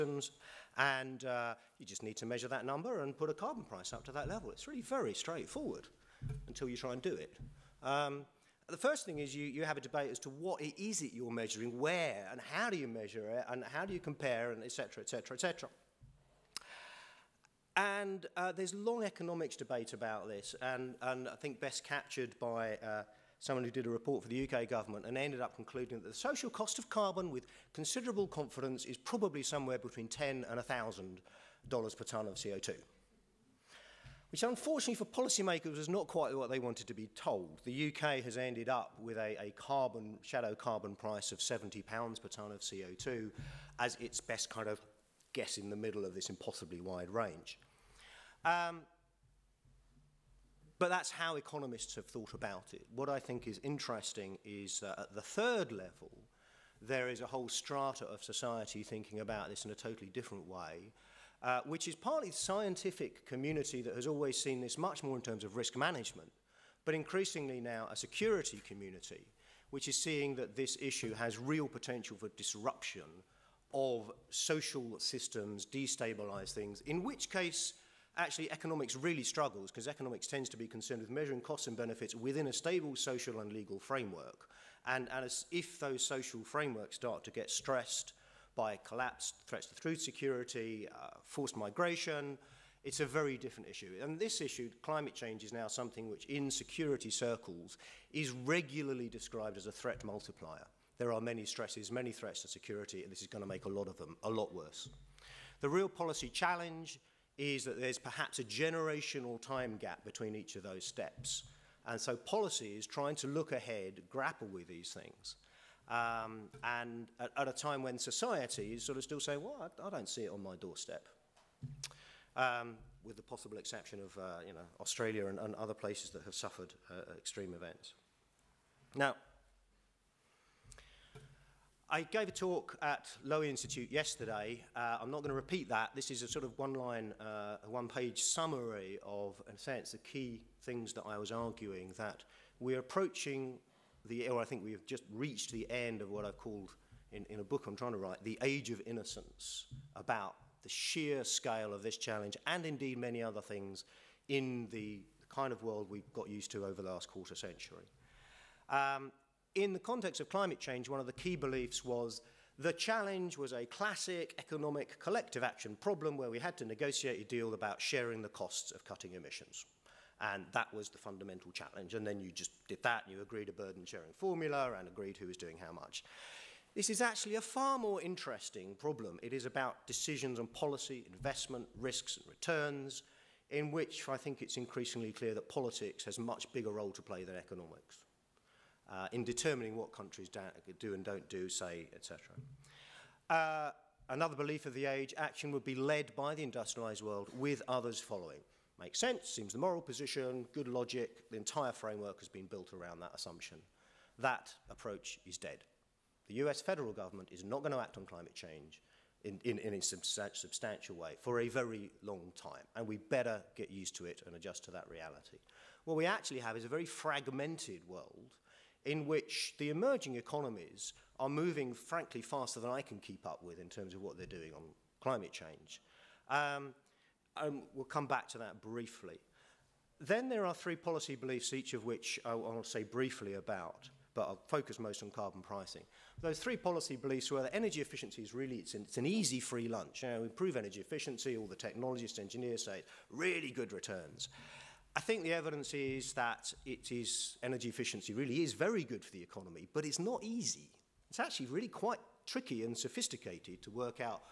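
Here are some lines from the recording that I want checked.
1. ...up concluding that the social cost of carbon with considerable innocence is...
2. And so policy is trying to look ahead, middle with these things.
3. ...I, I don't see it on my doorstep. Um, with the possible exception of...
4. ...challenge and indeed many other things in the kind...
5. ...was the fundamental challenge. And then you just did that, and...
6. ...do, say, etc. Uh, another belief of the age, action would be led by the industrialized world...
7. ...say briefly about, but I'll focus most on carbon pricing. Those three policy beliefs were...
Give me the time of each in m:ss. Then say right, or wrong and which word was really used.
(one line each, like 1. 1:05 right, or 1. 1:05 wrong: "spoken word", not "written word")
1. 0:25 wrong: "confidence", not "innocence"
2. 1:51 wrong: "grapple", not "middle"
3. 1:59 right
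4. 2:31 right
5. 2:50 right
6. 3:11 right
7. 3:52 right.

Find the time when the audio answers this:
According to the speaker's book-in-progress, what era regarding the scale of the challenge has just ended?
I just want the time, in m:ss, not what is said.
2:28.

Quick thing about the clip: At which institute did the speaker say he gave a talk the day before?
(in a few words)
Lowy Institute.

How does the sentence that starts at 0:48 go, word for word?
Um, but that's how economists have thought about it.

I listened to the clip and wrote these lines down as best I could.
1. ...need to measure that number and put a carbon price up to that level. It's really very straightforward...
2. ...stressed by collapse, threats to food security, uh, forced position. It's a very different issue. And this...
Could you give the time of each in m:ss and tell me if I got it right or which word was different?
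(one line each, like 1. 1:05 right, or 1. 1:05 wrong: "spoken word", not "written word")
1. 0:02 right
2. 1:27 wrong: "migration", not "position".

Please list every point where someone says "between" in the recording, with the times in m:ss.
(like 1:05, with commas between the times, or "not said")
0:29, 1:50.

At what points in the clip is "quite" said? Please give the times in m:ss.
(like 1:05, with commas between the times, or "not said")
0:36, 4:11.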